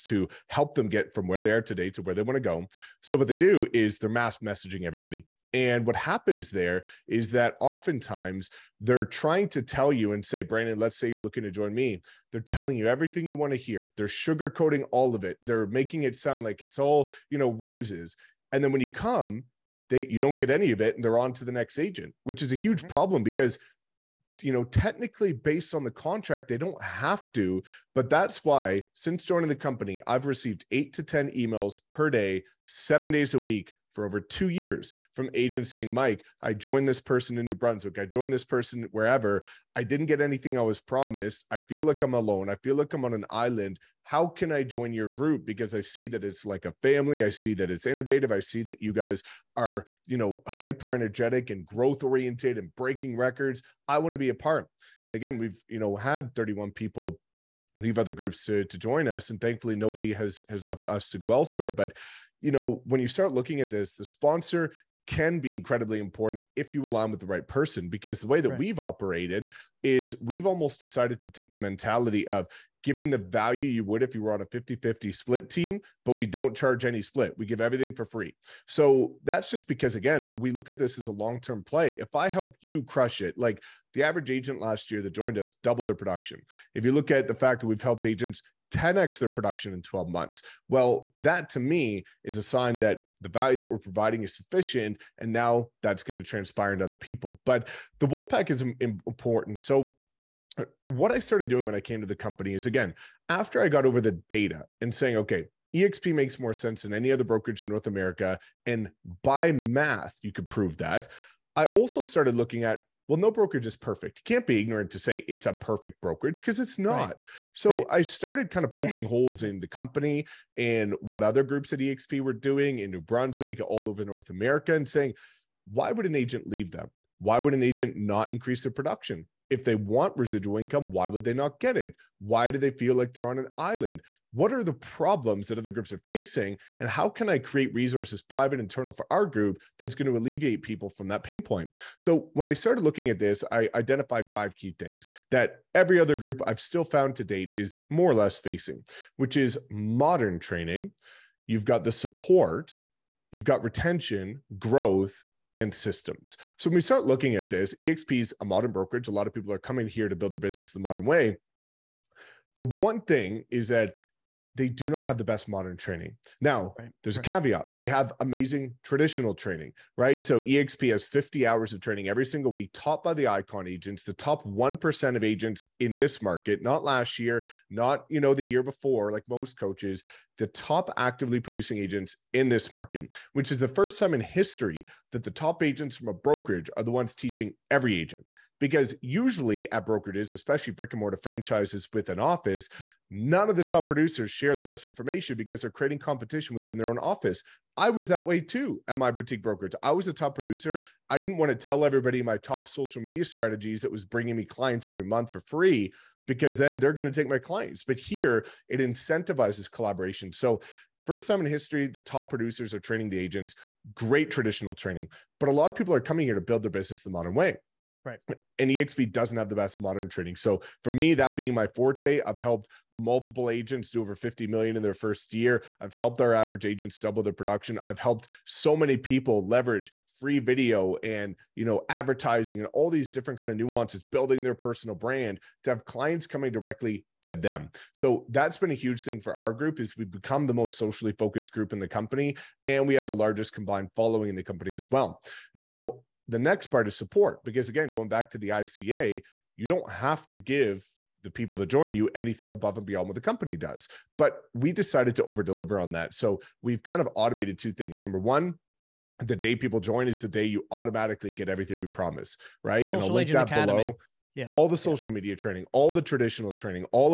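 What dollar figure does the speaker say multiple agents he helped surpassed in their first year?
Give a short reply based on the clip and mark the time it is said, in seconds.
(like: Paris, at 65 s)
Over $50 million, at 223 s.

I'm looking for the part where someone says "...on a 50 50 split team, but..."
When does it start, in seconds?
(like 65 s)
74 s.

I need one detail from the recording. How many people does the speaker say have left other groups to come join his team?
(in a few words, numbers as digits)
31.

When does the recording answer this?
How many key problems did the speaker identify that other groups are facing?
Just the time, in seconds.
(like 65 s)
144 s.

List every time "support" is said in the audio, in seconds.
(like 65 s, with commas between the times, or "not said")
151 s, 246 s.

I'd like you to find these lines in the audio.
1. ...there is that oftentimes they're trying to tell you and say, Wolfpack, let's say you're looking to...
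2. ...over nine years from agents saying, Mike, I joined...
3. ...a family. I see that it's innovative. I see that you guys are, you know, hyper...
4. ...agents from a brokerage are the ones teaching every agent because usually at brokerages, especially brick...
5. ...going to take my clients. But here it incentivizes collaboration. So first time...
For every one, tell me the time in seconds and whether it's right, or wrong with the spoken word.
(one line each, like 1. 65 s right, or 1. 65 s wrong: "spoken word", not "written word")
1. 6 s wrong: "Brandon", not "Wolfpack"
2. 34 s wrong: "two", not "nine"
3. 46 s right
4. 185 s right
5. 206 s right.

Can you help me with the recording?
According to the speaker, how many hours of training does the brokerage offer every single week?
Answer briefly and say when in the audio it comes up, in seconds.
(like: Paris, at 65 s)
50, at 171 s.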